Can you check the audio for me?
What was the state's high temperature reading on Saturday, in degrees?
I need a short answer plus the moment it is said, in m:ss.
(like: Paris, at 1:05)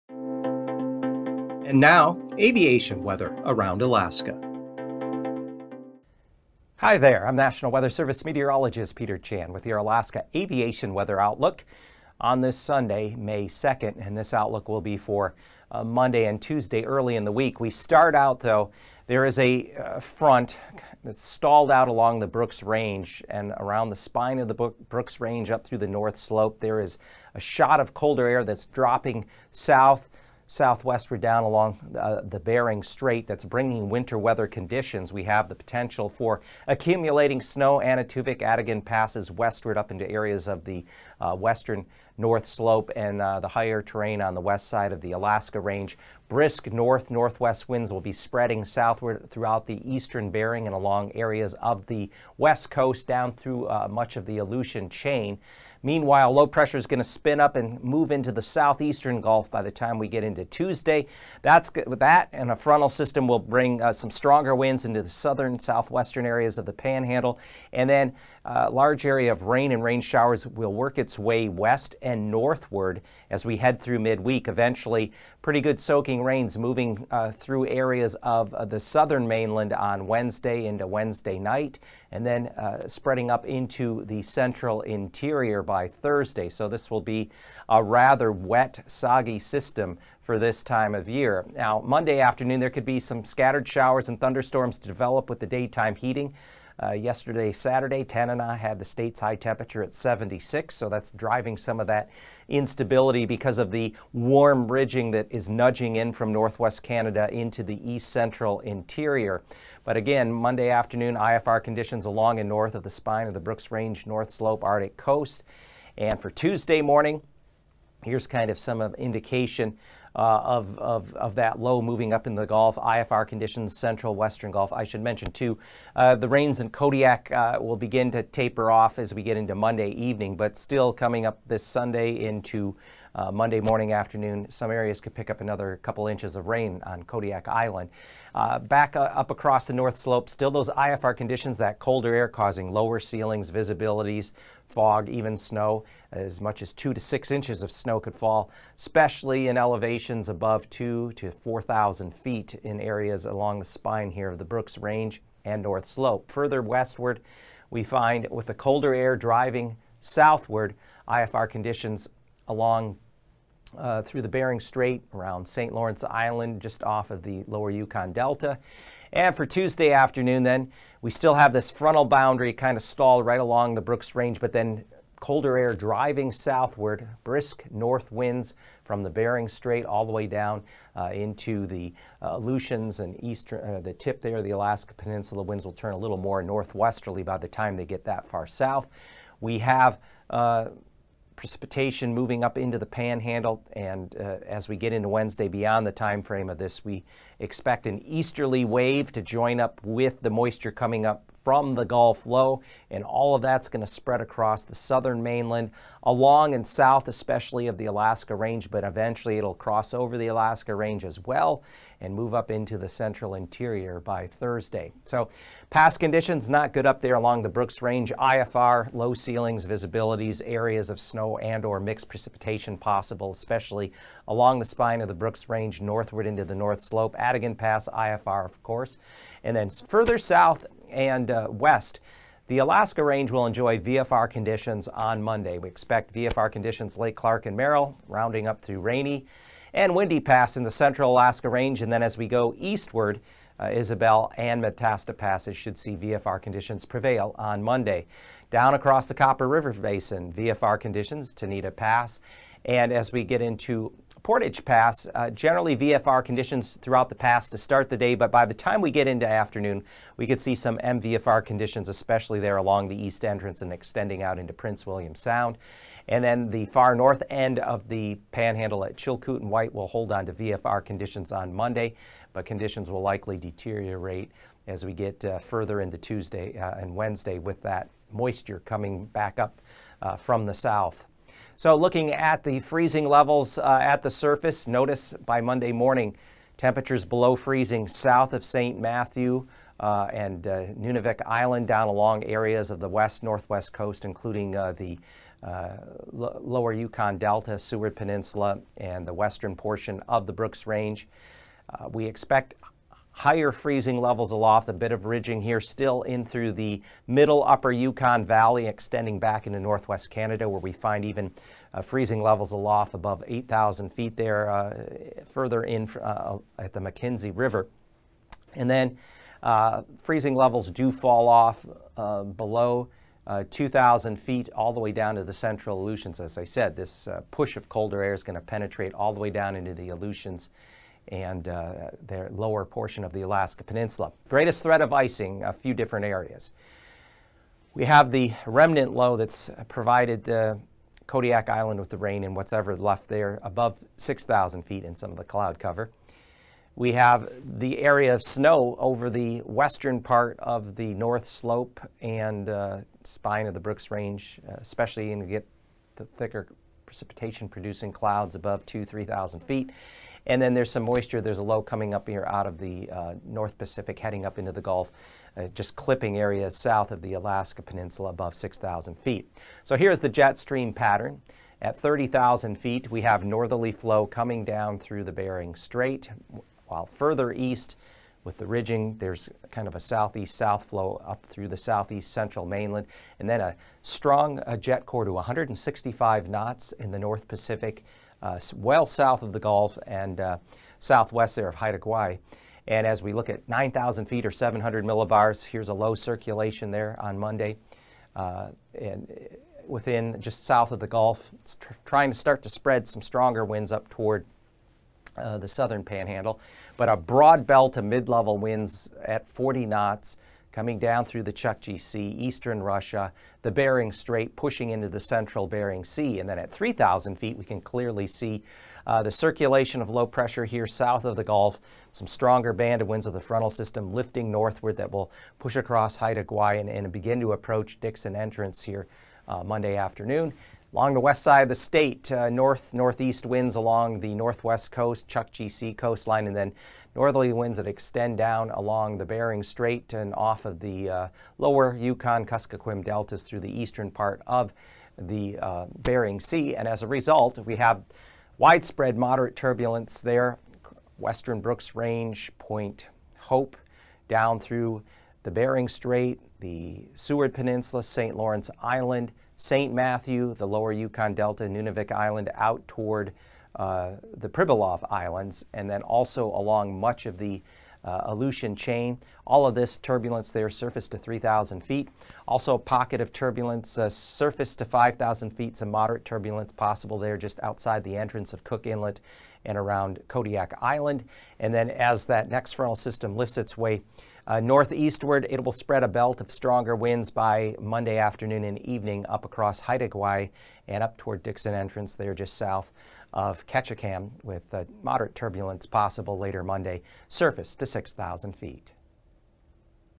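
76, at 1:39.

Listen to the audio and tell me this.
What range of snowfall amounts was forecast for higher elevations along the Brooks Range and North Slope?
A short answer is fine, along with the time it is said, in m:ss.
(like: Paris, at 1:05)
2 to 6 inches, at 2:26.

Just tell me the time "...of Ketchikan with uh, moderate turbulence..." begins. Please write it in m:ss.
8:13.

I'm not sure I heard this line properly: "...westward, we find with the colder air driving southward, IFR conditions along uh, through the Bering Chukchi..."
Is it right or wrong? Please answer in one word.
wrong.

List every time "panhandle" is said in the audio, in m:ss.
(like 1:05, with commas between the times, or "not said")
1:06, 3:12, 4:28, 6:45.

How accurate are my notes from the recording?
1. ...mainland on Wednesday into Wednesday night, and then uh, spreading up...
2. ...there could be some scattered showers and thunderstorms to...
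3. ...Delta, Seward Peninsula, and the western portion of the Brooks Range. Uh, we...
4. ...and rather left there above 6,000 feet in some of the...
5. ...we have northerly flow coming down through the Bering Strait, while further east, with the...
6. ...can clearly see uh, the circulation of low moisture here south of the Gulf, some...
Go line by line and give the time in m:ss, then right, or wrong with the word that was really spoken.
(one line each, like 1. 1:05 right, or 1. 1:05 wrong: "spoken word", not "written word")
1. 1:19 right
2. 1:32 right
3. 4:57 right
4. 5:42 wrong: "whatever", not "rather"
5. 6:12 right
6. 6:57 wrong: "pressure", not "moisture".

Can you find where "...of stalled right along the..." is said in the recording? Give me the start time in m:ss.
2:52.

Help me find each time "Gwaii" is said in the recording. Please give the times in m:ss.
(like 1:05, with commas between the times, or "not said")
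6:31, 7:06, 8:09.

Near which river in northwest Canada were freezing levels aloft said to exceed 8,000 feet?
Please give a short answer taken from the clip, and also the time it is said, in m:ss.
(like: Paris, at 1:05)
Mackenzie River, at 5:16.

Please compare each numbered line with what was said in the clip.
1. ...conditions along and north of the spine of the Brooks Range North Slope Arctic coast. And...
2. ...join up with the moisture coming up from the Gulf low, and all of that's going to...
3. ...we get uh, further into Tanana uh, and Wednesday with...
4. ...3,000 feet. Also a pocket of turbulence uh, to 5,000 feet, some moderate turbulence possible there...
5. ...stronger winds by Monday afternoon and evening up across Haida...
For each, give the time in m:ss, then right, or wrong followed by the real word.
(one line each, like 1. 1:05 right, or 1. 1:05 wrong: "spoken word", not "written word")
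1. 1:51 right
2. 3:19 right
3. 4:34 wrong: "Tuesday", not "Tanana"
4. 7:50 right
5. 8:06 right.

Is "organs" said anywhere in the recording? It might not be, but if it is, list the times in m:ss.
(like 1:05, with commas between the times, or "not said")
not said.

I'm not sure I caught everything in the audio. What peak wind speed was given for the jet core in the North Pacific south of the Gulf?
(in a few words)
165 knots.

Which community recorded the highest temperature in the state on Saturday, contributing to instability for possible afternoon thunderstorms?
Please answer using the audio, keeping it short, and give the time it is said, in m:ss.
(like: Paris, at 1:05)
Tanana, at 1:38.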